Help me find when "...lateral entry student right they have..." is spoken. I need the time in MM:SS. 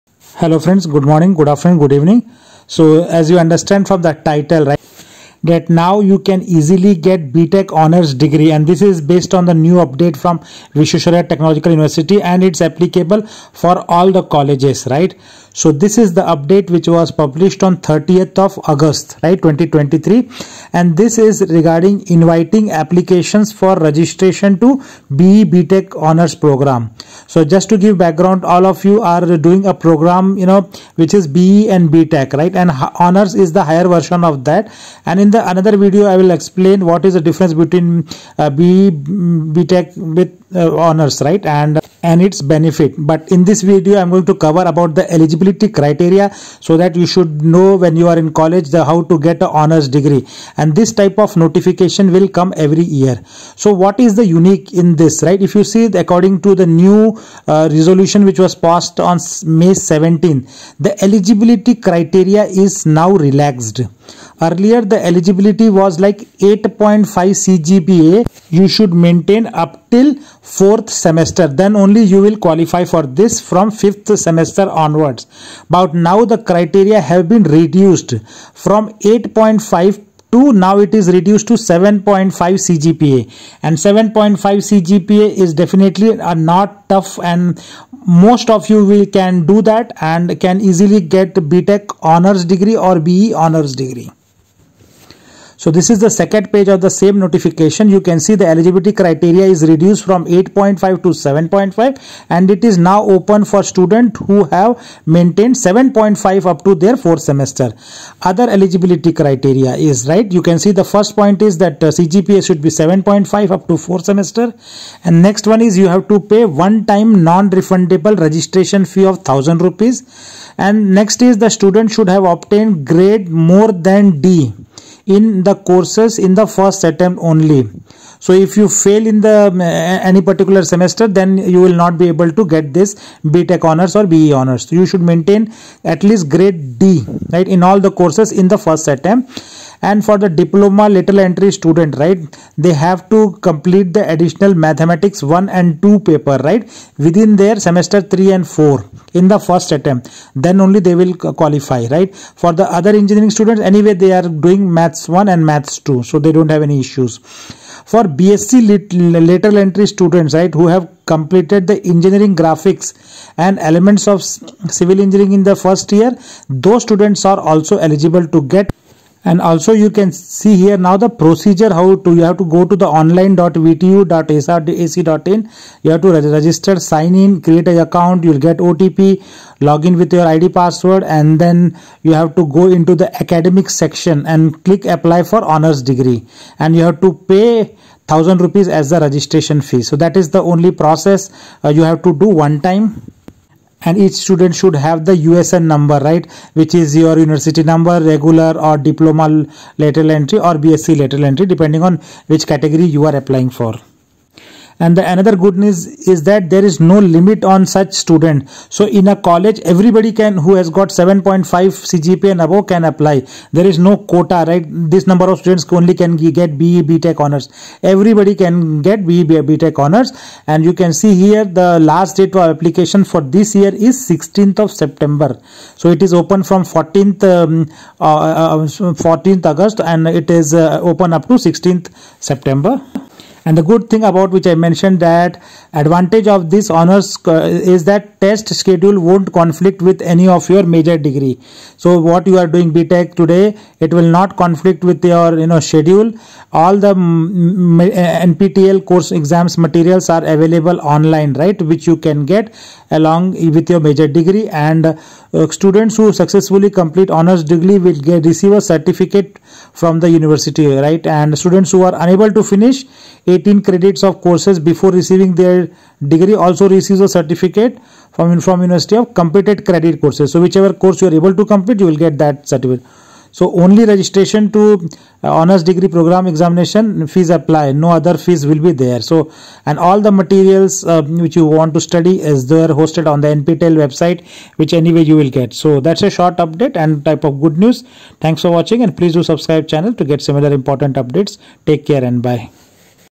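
02:20.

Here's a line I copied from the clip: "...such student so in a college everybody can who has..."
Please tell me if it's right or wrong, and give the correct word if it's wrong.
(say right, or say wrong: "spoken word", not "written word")
right.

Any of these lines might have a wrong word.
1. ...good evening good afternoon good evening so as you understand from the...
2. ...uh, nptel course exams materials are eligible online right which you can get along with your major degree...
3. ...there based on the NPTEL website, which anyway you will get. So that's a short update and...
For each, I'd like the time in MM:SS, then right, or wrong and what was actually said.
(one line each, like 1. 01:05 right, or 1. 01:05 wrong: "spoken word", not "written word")
1. 00:00 wrong: "morning", not "evening"
2. 04:06 wrong: "available", not "eligible"
3. 04:42 wrong: "hosted", not "based".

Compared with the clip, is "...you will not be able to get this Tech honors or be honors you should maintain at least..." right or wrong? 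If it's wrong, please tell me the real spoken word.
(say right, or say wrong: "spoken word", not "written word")
right.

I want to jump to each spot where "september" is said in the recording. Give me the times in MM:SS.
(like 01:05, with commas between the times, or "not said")
03:44, 03:52.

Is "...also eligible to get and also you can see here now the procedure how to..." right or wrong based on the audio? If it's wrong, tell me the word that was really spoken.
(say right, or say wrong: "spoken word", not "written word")
right.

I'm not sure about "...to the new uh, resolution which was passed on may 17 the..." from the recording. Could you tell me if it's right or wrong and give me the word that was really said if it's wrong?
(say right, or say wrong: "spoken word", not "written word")
right.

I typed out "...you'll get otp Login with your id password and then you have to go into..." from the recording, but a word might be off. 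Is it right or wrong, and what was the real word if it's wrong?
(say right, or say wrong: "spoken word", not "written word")
right.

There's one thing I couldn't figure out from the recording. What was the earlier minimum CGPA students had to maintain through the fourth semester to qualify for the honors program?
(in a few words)
8.5.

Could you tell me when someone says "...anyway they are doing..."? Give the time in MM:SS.
02:33.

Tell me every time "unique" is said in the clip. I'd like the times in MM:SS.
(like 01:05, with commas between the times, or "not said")
00:54.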